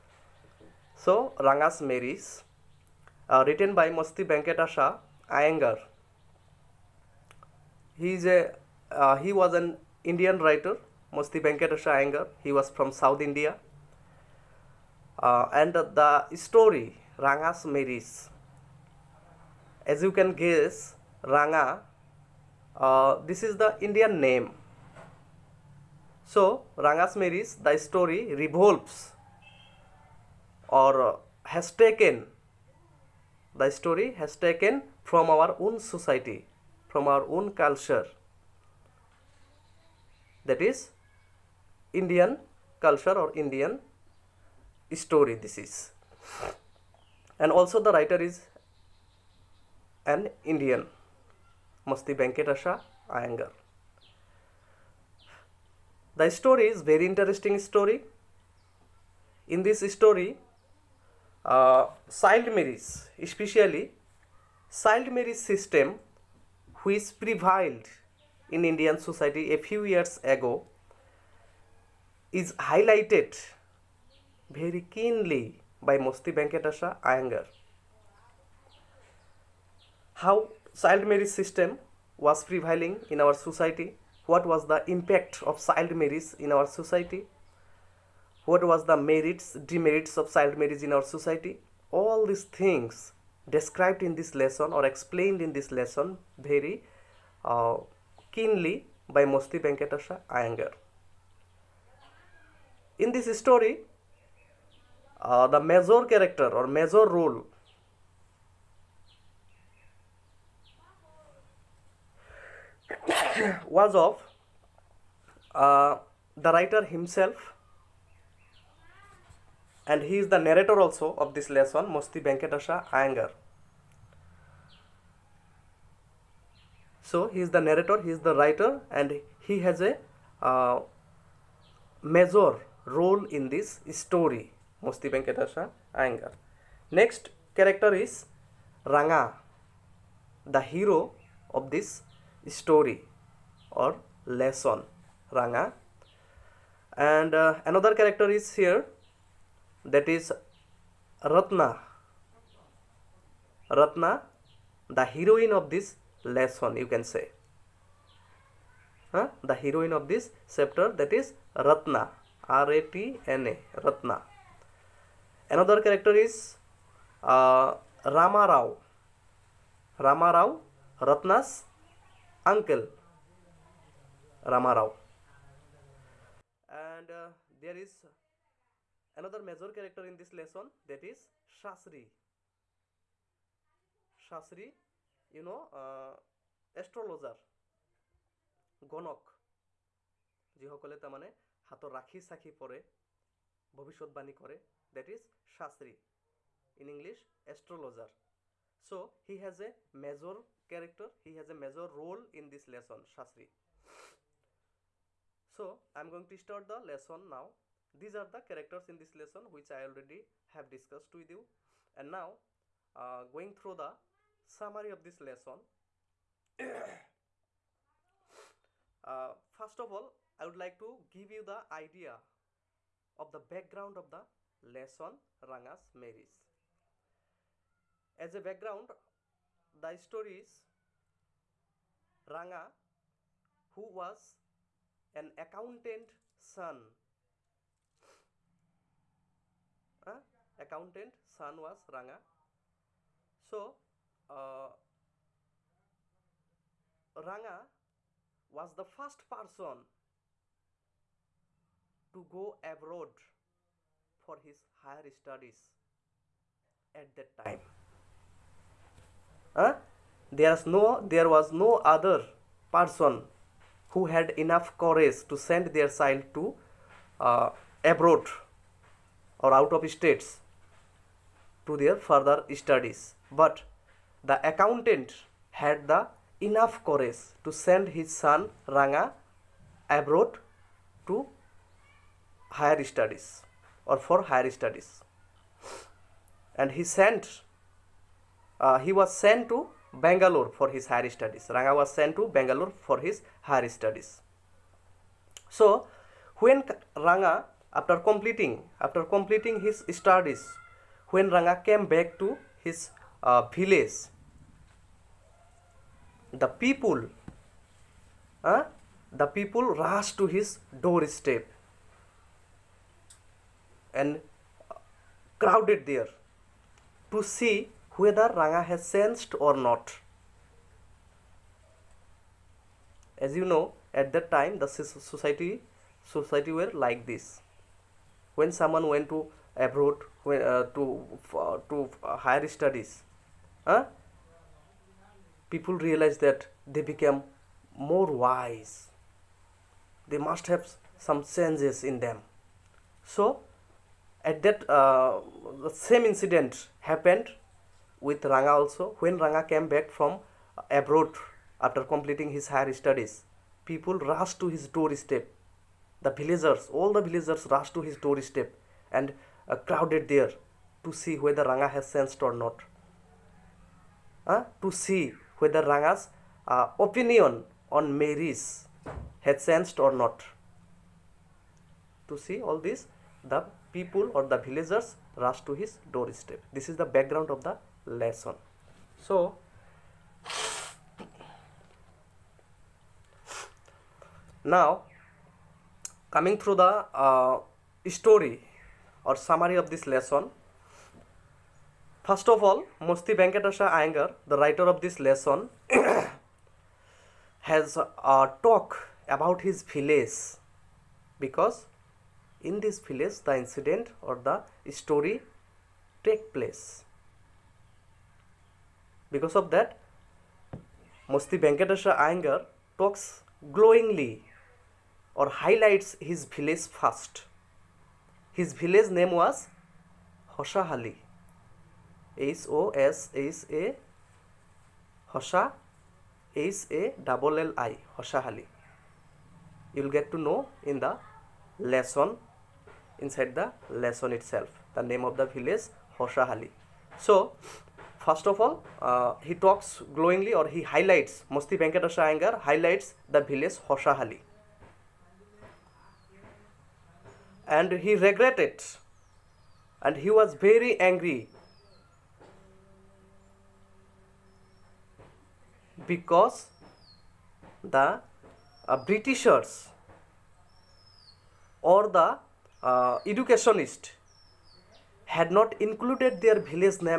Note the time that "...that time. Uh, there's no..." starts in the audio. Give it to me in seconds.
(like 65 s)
257 s.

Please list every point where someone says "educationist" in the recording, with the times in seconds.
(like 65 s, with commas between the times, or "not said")
463 s.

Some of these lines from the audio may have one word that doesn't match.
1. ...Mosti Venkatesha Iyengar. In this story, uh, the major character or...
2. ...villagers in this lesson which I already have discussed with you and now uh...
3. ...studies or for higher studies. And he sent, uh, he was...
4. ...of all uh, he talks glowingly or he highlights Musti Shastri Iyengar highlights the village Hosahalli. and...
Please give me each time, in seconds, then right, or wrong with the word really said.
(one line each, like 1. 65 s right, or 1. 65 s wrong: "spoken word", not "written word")
1. 99 s right
2. 208 s wrong: "characters", not "villagers"
3. 282 s right
4. 438 s wrong: "Venkatesha", not "Shastri".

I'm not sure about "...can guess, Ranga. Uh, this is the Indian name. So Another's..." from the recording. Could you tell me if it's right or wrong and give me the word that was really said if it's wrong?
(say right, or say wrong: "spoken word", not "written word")
wrong: "Ranga", not "Another".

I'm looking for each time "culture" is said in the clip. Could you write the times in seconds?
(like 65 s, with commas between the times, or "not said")
37 s, 42 s.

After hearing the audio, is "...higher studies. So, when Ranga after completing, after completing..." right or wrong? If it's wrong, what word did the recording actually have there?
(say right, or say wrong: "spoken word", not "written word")
right.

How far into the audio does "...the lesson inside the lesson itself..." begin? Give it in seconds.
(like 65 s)
430 s.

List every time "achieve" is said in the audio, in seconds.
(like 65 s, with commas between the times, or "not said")
not said.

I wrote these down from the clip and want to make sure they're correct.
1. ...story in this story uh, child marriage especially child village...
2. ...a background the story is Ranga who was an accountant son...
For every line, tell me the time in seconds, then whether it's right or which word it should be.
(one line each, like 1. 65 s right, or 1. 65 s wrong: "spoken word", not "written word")
1. 57 s wrong: "marriage", not "village"
2. 228 s right.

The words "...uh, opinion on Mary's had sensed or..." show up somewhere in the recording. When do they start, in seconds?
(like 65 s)
366 s.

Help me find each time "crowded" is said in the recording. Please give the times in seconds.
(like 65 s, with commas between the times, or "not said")
315 s, 359 s.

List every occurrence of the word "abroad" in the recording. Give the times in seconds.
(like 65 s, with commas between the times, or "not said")
252 s, 267 s, 279 s, 329 s, 350 s.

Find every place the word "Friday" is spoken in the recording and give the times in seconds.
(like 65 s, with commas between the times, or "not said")
not said.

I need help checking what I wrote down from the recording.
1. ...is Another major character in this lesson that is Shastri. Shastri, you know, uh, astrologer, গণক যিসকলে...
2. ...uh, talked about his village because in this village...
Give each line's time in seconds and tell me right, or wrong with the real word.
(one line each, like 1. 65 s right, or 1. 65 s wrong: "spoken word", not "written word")
1. 177 s right
2. 397 s right.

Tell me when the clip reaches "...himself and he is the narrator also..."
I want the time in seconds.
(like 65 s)
116 s.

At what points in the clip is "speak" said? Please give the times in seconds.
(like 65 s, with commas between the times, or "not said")
not said.